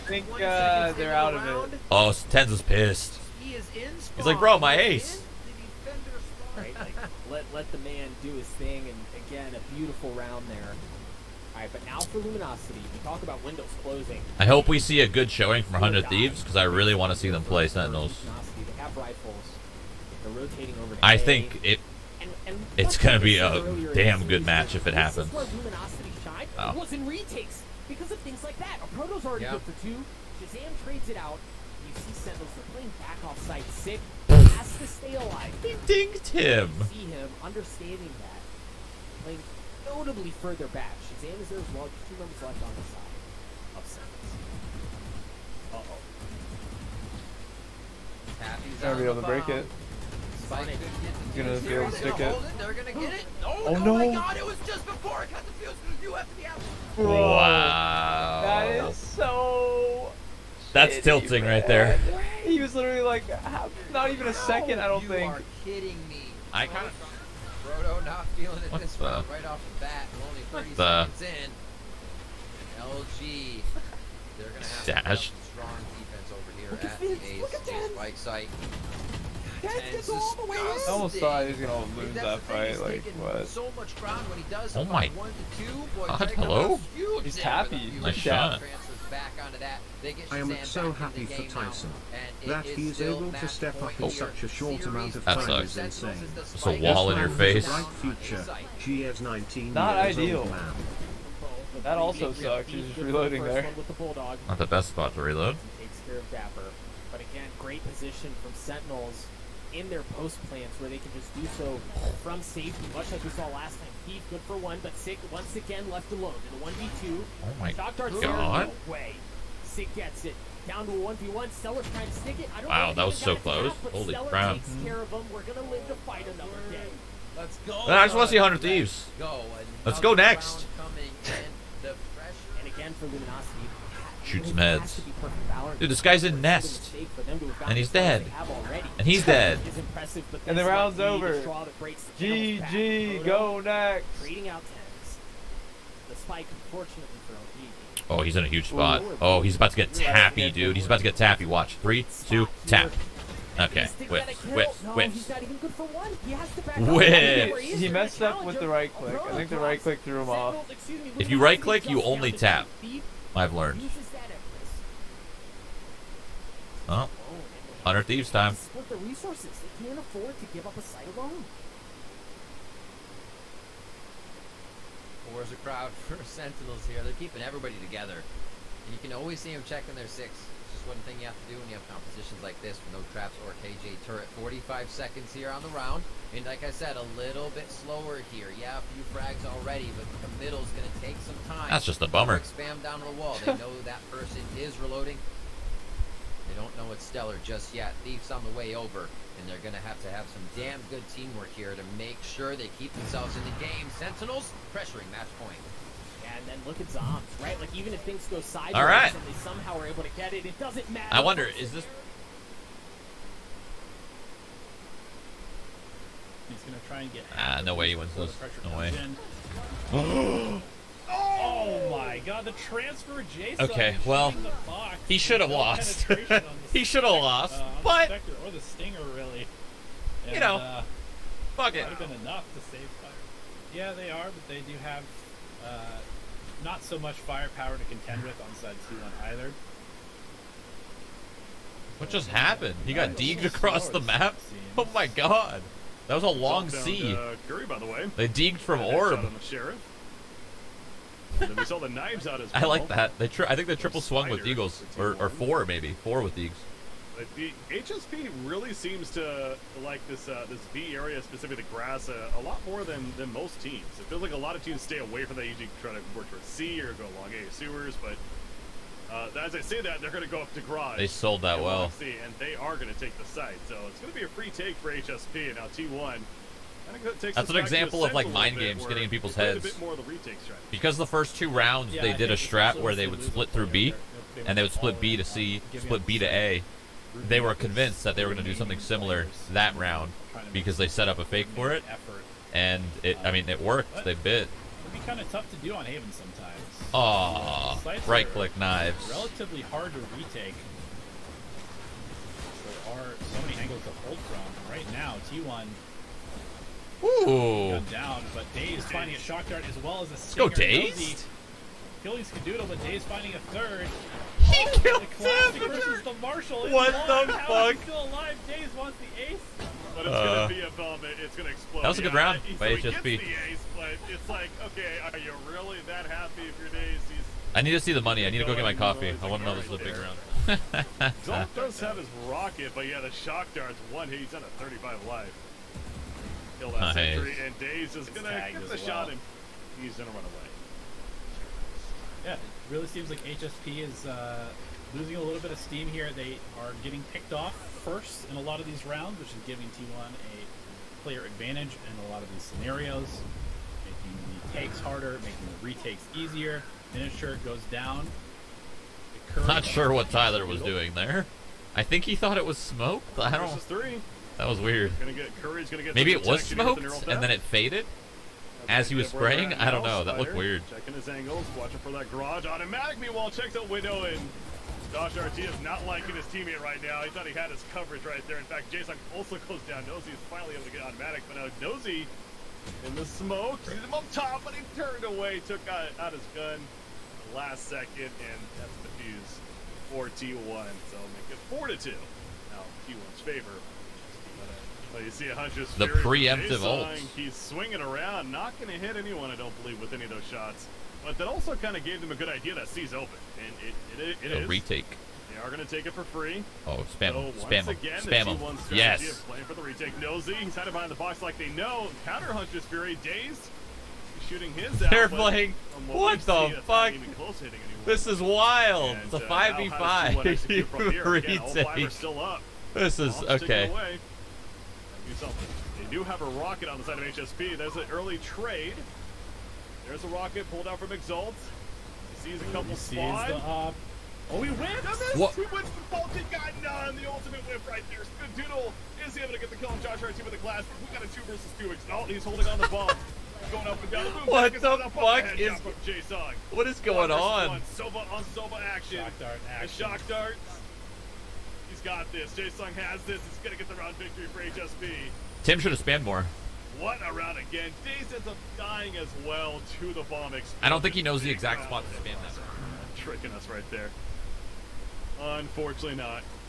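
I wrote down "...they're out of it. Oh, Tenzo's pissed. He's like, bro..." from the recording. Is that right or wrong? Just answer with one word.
right.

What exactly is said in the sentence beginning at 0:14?
I hope we see a good showing from 100 Thieves because I really want to see them play Sentinels.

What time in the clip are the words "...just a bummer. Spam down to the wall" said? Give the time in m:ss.
3:11.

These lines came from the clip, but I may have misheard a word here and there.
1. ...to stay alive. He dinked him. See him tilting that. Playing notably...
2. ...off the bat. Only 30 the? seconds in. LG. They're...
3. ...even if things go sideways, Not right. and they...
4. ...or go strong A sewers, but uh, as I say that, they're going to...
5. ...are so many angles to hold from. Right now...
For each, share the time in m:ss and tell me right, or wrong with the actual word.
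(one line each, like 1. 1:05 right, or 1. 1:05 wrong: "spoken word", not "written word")
1. 0:34 wrong: "understanding", not "tilting"
2. 1:09 right
3. 3:27 wrong: "All", not "Not"
4. 4:26 wrong: "along", not "strong"
5. 5:02 right.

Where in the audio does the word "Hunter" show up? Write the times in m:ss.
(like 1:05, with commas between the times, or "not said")
2:47, 6:35, 6:52.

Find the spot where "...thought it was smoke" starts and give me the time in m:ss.
6:02.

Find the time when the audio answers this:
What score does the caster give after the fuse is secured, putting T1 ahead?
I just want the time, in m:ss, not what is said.
6:31.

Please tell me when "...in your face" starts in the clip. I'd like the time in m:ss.
1:37.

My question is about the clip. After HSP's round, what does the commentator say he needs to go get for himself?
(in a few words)
Coffee.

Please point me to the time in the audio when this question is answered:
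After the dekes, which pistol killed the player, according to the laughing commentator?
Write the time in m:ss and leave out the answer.
4:09.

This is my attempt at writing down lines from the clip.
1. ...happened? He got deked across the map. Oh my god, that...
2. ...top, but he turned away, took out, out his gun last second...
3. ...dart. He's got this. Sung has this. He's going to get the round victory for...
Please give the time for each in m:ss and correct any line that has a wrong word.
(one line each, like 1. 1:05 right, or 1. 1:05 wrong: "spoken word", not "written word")
1. 4:02 right
2. 6:24 right
3. 7:30 right.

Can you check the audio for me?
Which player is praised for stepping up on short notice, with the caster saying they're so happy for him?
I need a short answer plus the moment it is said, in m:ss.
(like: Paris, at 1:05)
Tyson, at 1:31.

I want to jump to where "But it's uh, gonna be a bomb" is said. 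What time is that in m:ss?
5:19.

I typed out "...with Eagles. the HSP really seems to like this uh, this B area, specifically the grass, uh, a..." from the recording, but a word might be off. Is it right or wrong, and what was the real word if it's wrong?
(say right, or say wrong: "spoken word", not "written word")
right.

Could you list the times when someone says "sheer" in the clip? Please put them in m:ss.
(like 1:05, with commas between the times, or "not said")
not said.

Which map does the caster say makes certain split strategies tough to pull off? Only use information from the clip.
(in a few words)
Haven.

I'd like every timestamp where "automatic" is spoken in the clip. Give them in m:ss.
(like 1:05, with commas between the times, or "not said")
6:12, 6:20.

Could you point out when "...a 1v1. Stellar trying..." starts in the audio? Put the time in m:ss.
2:00.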